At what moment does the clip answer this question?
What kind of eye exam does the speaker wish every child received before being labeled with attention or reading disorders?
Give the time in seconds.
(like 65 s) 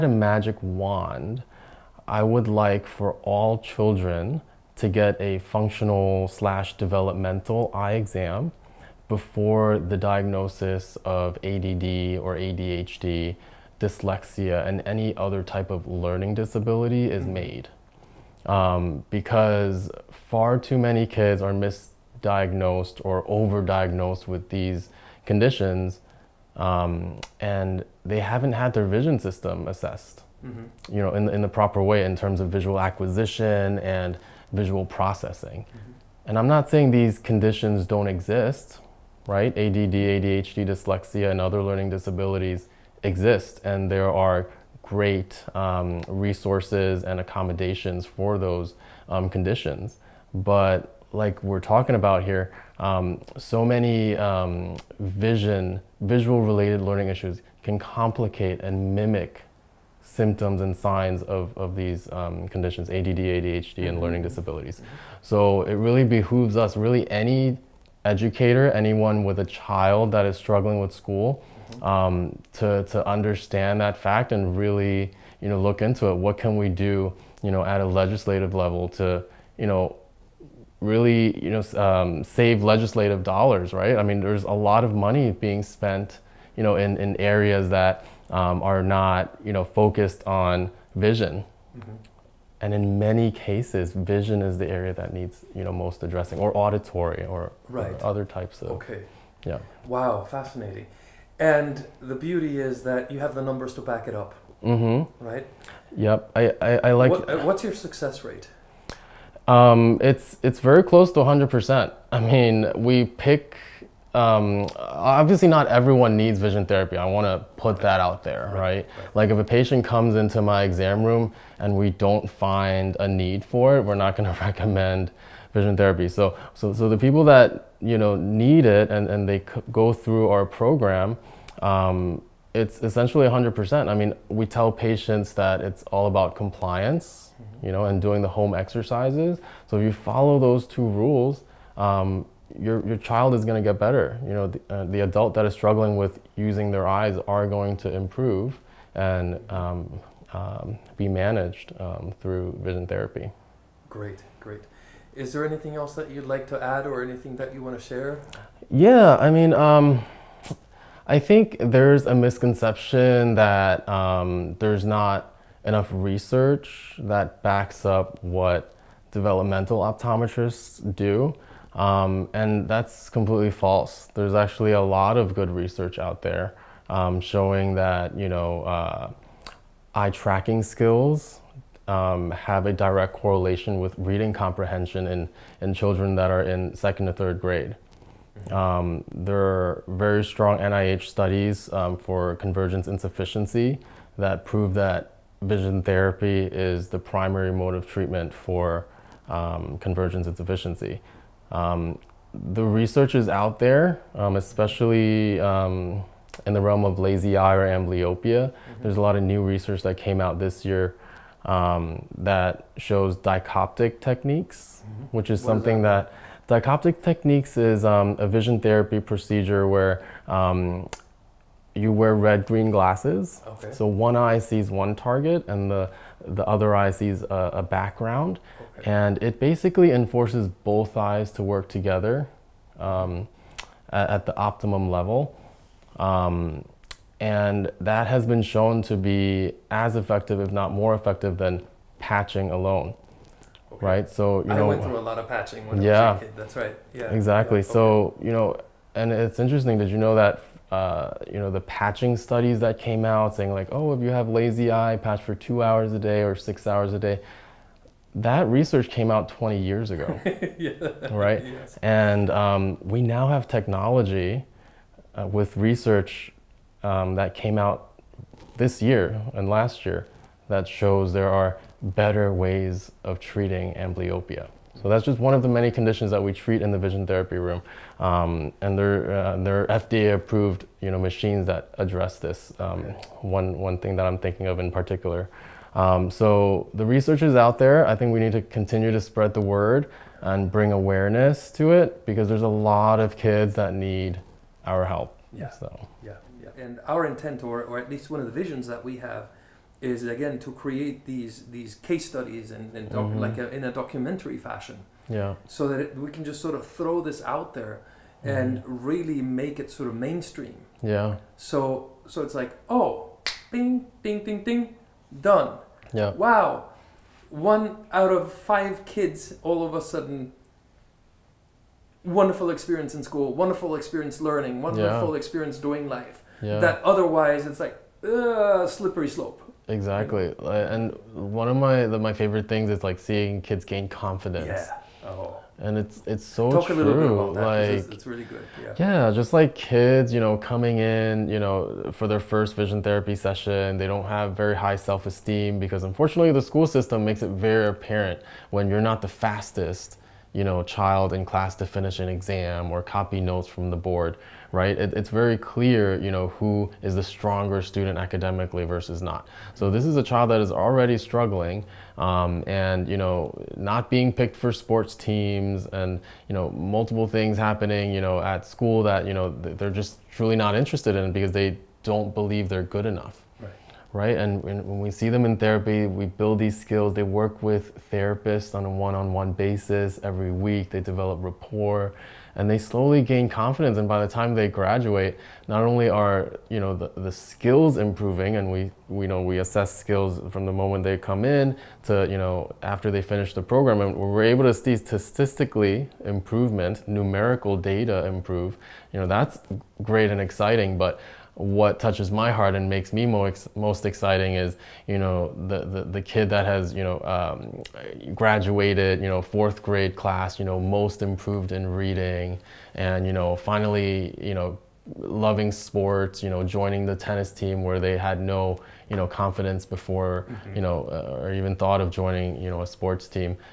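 5 s.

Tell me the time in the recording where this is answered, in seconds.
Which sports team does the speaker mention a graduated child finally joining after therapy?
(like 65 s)
416 s.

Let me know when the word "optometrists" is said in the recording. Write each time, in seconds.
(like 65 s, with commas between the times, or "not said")
169 s.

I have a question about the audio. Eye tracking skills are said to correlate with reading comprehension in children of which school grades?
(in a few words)
second to third grade.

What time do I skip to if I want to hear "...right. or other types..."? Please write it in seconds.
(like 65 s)
97 s.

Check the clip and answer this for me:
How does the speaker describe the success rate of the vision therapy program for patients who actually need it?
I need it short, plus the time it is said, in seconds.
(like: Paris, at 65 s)
close to 100%, at 110 s.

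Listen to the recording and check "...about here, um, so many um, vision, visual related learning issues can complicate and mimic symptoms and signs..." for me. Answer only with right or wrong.
right.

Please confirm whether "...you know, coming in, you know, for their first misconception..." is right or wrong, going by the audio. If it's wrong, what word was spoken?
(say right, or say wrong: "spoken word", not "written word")
wrong: "vision", not "misconception".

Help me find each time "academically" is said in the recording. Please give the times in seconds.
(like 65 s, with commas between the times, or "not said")
357 s.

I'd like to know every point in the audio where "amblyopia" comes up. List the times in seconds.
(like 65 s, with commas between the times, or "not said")
207 s, 273 s.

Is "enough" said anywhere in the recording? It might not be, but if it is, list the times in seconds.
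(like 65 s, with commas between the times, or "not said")
165 s, 372 s.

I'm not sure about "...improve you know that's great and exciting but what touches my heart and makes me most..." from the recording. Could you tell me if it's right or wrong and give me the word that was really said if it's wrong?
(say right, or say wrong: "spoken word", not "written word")
right.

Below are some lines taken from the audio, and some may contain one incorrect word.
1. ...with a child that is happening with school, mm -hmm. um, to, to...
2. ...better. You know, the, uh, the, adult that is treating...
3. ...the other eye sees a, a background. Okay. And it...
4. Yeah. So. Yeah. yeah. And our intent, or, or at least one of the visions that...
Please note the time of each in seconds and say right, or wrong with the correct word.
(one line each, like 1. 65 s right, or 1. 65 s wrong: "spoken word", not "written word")
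1. 69 s wrong: "struggling", not "happening"
2. 143 s wrong: "struggling", not "treating"
3. 226 s right
4. 295 s right.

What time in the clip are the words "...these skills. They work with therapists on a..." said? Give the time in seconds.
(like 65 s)
376 s.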